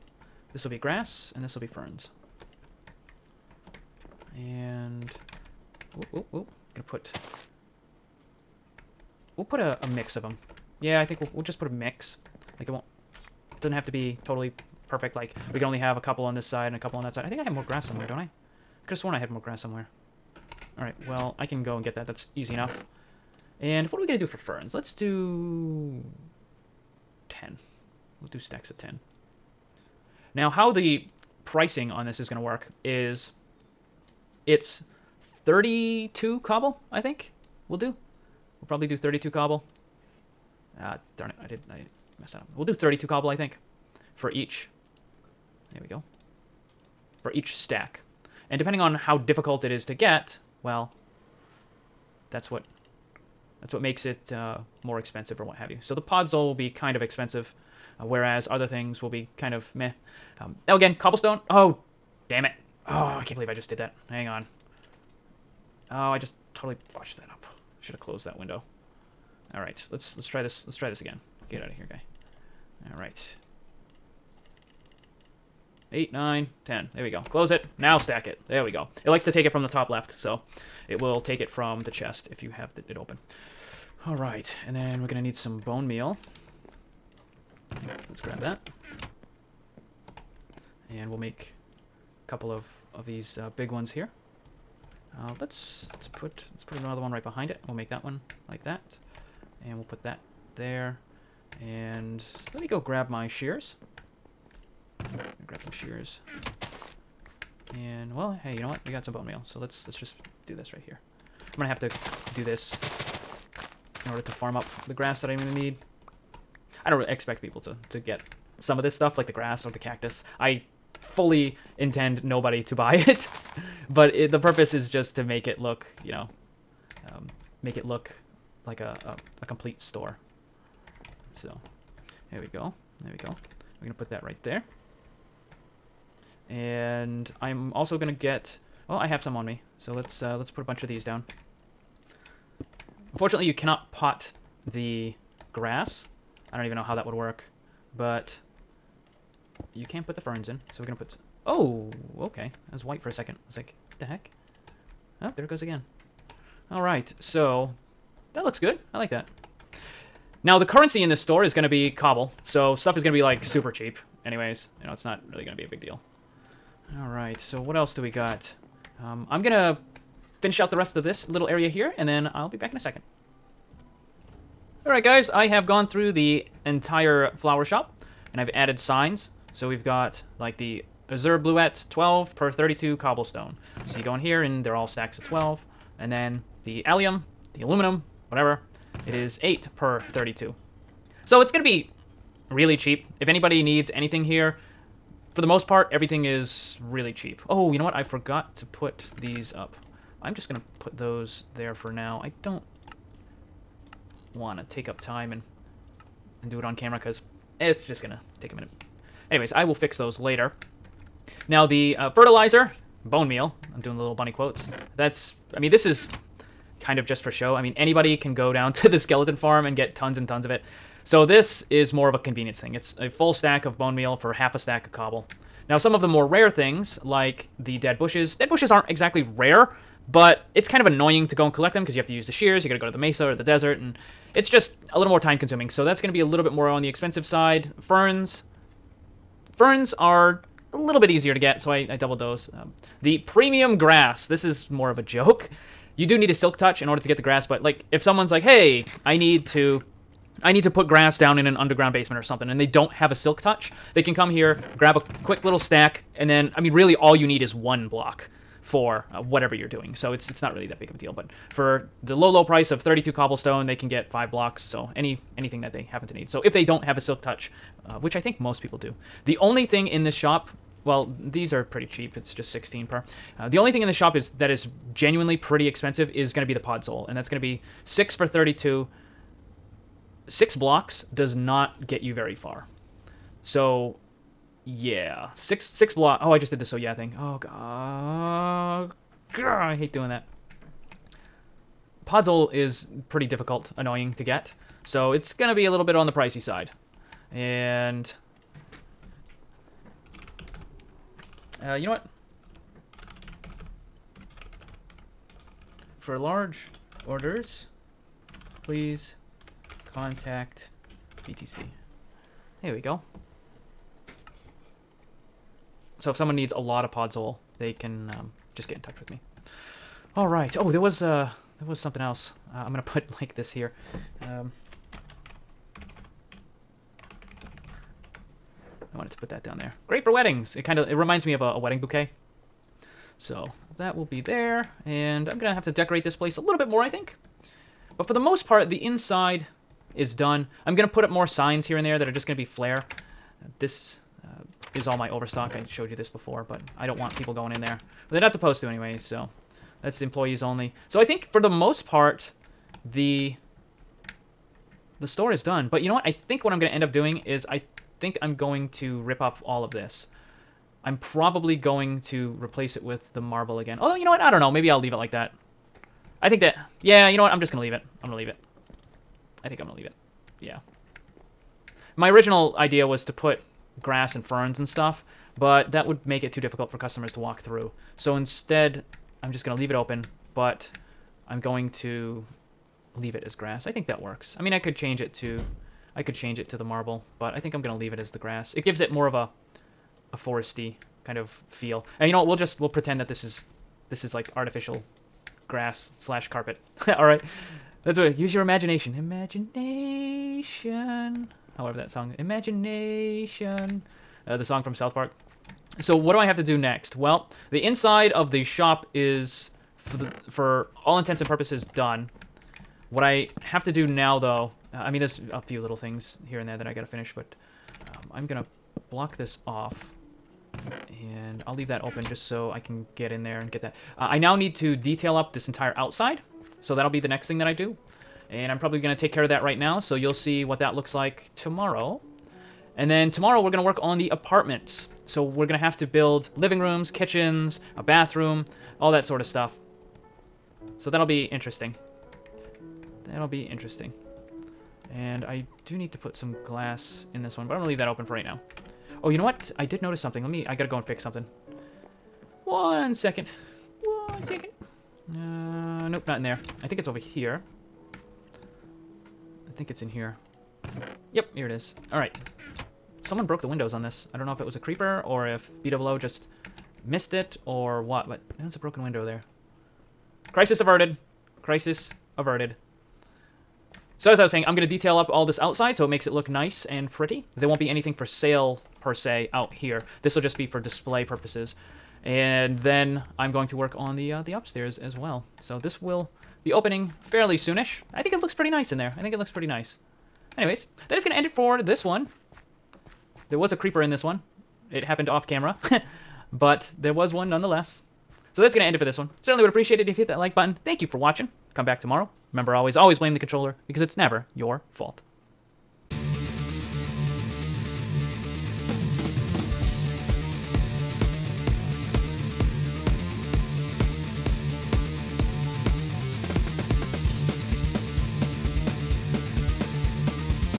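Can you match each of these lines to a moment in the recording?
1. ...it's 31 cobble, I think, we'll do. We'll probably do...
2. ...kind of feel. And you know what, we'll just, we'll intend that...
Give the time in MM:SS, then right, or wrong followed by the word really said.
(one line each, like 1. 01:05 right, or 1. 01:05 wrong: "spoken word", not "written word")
1. 00:34 wrong: "32", not "31"
2. 06:31 wrong: "pretend", not "intend".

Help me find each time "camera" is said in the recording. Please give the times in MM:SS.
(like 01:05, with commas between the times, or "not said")
03:26, 08:15.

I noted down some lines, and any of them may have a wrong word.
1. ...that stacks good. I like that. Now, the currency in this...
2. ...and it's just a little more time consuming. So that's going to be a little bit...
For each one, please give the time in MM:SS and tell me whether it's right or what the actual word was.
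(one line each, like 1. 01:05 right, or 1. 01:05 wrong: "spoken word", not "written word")
1. 02:38 wrong: "looks", not "stacks"
2. 03:53 right.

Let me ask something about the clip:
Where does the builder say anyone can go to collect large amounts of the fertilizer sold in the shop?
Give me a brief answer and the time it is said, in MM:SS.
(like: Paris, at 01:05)
Skeleton farm, at 03:38.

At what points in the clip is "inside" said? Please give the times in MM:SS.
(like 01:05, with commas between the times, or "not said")
05:38, 06:47.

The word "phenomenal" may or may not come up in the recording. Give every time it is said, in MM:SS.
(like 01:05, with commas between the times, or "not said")
not said.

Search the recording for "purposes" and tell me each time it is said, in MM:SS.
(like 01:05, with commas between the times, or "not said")
02:04, 06:51, 08:01.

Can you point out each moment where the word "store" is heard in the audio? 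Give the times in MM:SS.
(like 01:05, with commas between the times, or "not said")
02:09, 02:41, 05:55.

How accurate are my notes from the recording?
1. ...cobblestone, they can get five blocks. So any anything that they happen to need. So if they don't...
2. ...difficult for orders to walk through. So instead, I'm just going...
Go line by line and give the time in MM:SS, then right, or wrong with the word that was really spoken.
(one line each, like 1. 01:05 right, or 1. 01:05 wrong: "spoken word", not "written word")
1. 04:23 right
2. 06:16 wrong: "customers", not "orders".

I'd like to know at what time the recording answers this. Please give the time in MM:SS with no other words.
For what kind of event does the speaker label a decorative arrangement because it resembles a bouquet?
05:30.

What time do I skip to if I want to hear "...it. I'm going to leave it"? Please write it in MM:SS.
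06:07.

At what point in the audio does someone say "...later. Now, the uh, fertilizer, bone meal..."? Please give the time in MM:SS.
03:30.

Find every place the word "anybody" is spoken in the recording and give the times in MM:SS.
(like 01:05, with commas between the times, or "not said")
03:13, 03:37.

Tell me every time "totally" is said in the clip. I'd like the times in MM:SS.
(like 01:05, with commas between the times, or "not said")
00:14, 01:06.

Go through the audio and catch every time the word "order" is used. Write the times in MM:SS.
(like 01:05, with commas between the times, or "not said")
01:54, 04:06, 05:07.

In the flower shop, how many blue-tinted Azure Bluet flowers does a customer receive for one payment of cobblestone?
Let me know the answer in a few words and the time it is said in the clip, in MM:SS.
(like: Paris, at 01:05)
12, at 03:01.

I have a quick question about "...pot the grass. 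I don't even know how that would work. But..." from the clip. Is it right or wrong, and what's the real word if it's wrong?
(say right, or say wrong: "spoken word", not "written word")
right.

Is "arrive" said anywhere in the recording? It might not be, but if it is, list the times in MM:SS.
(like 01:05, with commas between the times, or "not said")
not said.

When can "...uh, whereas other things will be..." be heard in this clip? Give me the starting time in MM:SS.
00:58.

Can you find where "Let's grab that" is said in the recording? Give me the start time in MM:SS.
01:28.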